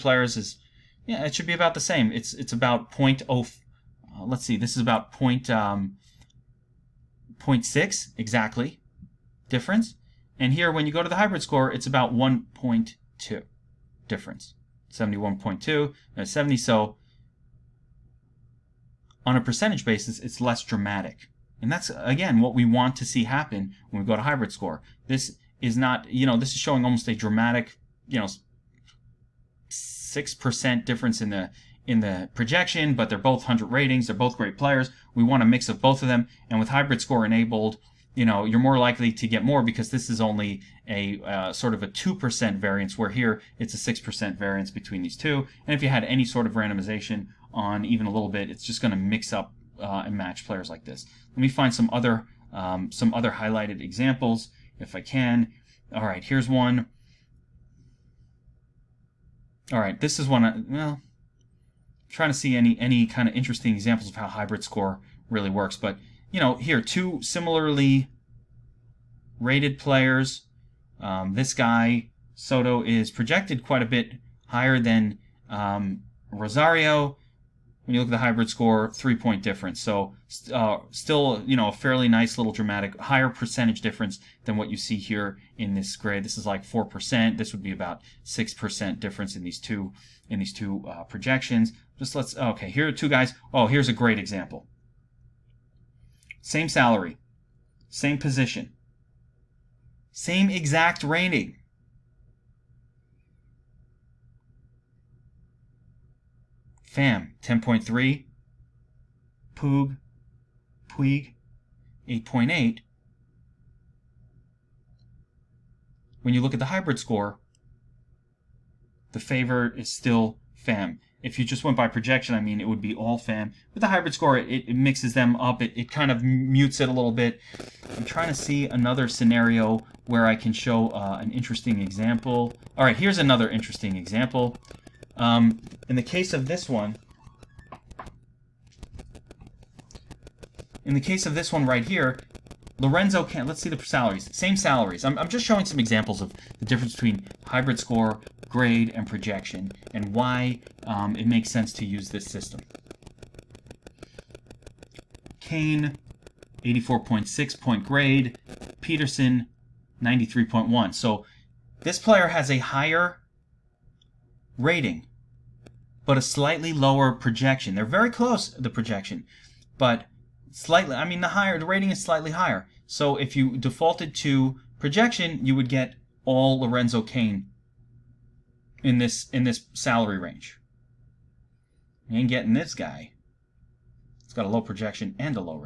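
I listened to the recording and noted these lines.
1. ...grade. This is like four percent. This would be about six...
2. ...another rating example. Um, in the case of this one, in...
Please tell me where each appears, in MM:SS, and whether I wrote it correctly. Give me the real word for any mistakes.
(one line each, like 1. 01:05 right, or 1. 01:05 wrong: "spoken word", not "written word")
1. 01:25 right
2. 02:13 wrong: "interesting", not "rating".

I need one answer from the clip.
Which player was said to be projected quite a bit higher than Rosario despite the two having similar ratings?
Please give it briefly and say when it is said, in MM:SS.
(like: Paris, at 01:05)
Soto, at 01:12.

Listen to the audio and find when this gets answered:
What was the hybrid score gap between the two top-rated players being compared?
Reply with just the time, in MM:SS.
00:12.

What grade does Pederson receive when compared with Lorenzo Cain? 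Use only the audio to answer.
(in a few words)
93.1.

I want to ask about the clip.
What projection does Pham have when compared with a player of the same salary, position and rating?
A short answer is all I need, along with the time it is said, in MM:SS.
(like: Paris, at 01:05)
10.3, at 01:47.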